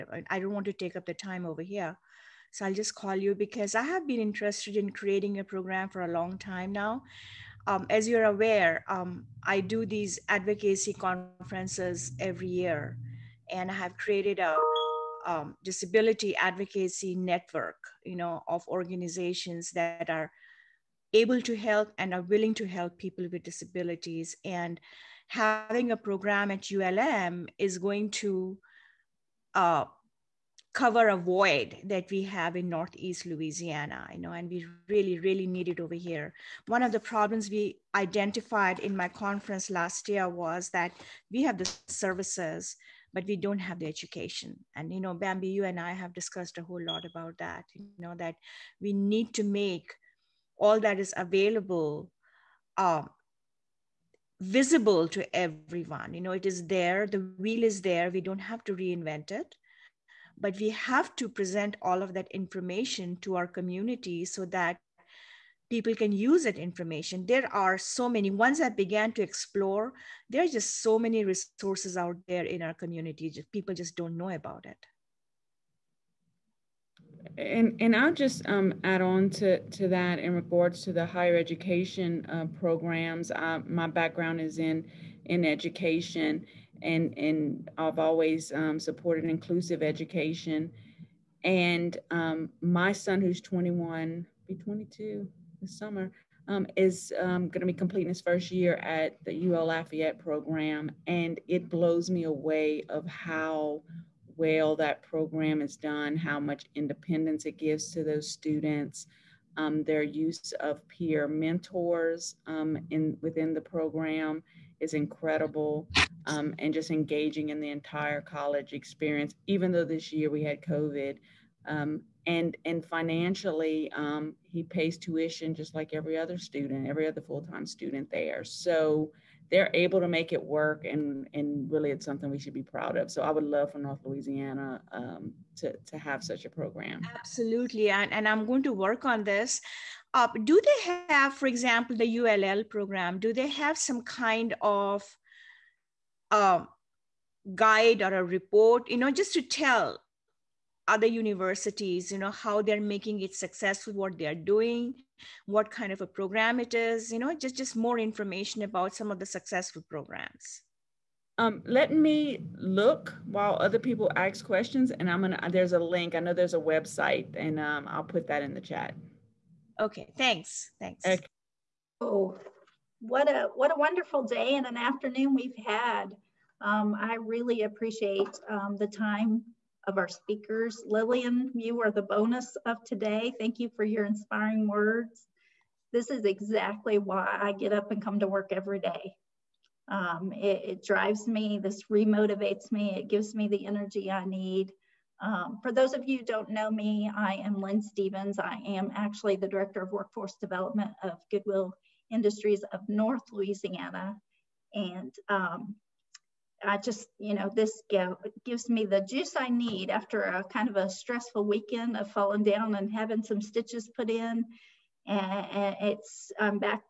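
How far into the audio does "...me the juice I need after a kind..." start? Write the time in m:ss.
3:28.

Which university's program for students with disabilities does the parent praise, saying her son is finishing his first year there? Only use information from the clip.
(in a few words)
UL Lafayette.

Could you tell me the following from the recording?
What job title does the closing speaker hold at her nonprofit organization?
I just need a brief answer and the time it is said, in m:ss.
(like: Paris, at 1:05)
Director of Workforce Development, at 3:19.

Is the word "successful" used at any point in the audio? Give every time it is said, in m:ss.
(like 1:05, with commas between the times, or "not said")
2:33, 2:39.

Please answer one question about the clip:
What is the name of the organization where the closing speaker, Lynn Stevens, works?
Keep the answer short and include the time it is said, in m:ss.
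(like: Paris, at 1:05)
Goodwill Industries of North Louisiana, at 3:21.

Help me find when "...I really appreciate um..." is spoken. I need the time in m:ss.
2:56.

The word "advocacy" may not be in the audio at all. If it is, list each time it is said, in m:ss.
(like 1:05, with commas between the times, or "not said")
0:10, 0:16.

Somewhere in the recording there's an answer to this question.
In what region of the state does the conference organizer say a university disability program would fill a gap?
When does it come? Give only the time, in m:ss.
0:32.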